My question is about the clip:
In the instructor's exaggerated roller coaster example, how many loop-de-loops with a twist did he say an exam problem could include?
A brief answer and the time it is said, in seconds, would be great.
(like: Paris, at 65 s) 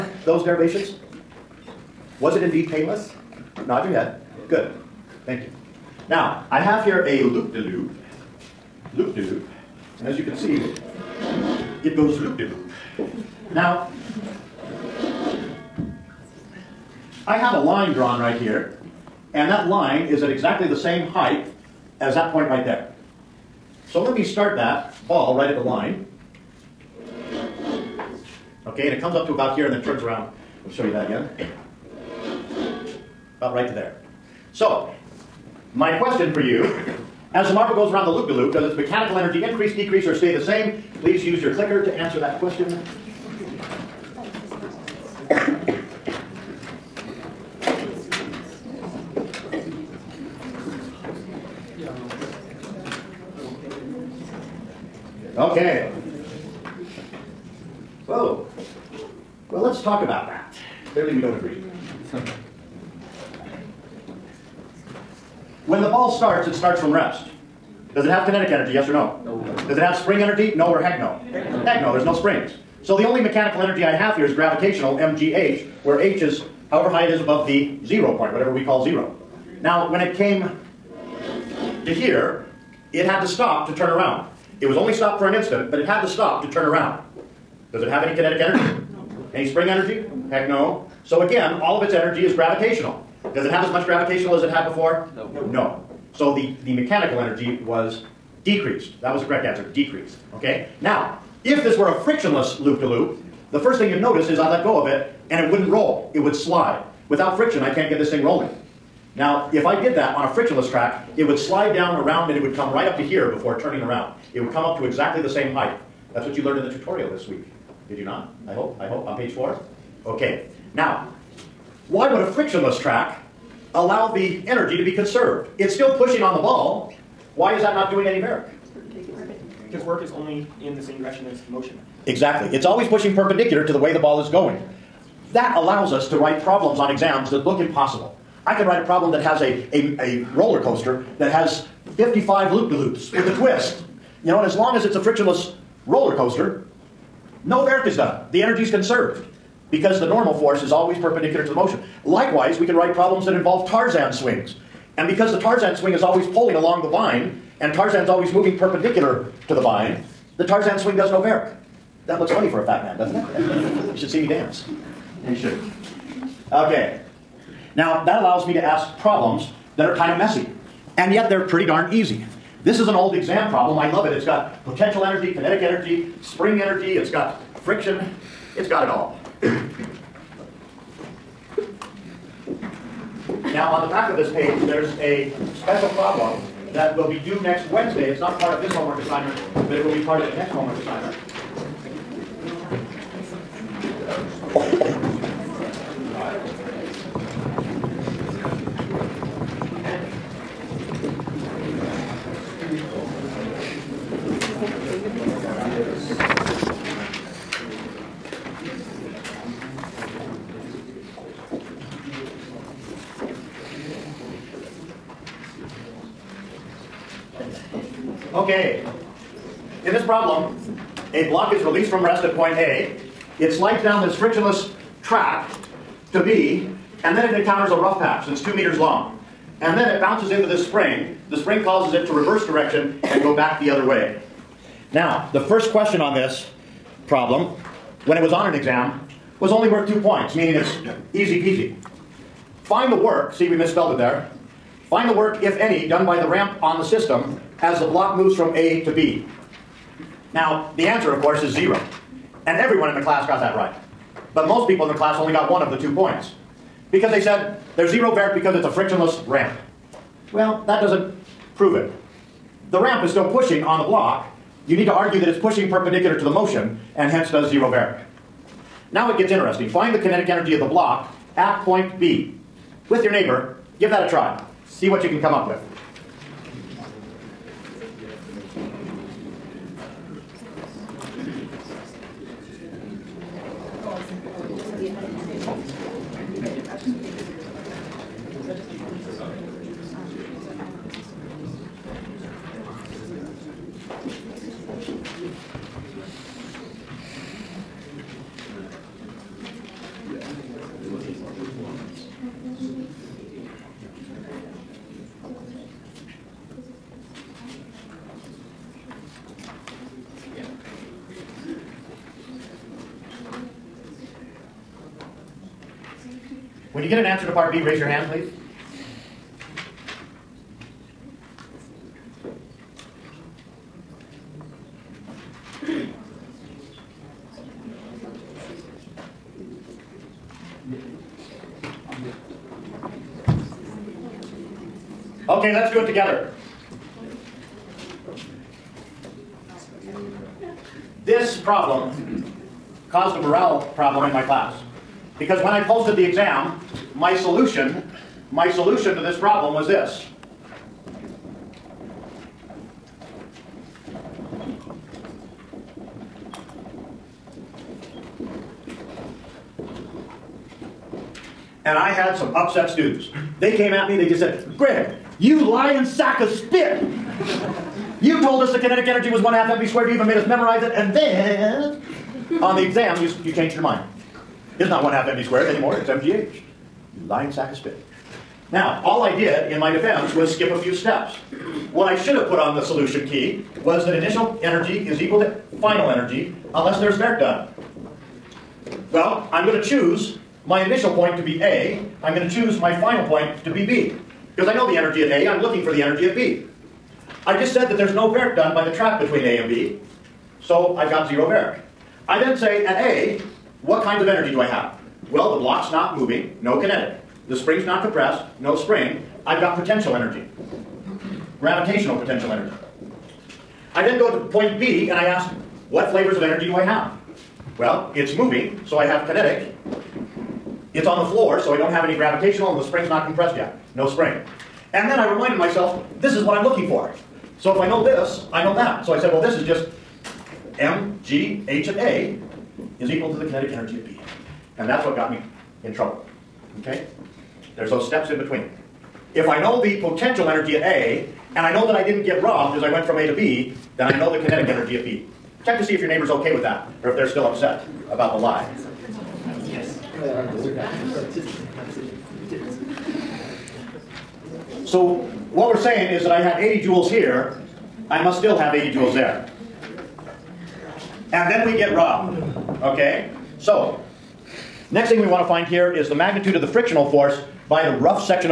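55, at 141 s.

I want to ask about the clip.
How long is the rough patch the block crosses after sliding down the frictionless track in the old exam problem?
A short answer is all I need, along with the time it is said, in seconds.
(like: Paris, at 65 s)
2 meters, at 228 s.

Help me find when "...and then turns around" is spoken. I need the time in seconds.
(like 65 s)
29 s.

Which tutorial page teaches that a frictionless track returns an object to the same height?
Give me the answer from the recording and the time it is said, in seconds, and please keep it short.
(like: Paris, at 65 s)
Page 4, at 119 s.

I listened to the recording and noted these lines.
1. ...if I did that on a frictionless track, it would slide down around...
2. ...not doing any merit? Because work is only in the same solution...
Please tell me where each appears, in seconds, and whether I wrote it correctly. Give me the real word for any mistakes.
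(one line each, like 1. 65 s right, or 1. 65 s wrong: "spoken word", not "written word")
1. 109 s right
2. 127 s wrong: "direction", not "solution".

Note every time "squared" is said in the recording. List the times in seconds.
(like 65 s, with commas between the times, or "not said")
369 s, 375 s.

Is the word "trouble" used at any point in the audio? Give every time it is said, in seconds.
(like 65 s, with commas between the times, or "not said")
435 s.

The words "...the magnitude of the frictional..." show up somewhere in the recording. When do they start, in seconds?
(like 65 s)
465 s.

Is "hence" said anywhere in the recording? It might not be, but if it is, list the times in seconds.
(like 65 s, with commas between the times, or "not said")
267 s.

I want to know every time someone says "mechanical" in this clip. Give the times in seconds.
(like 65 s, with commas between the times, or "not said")
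38 s, 73 s, 96 s.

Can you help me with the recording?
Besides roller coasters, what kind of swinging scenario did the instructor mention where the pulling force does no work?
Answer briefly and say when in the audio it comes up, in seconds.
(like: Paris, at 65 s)
Tarzan swings, at 153 s.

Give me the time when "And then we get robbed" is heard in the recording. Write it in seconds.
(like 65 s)
461 s.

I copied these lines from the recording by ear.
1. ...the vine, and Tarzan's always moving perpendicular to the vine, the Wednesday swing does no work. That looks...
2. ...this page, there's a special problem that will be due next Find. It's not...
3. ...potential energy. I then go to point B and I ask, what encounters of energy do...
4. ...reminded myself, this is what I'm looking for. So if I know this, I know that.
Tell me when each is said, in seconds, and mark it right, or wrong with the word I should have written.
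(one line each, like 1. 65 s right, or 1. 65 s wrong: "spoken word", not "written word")
1. 156 s wrong: "Tarzan", not "Wednesday"
2. 184 s wrong: "Wednesday", not "Find"
3. 412 s wrong: "flavors", not "encounters"
4. 425 s right.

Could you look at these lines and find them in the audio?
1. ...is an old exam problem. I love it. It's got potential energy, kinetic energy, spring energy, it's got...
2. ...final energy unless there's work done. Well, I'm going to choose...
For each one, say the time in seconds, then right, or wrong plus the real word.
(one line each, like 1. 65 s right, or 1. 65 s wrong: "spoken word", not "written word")
1. 172 s right
2. 385 s right.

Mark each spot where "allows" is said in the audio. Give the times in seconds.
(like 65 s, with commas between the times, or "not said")
123 s, 135 s, 168 s.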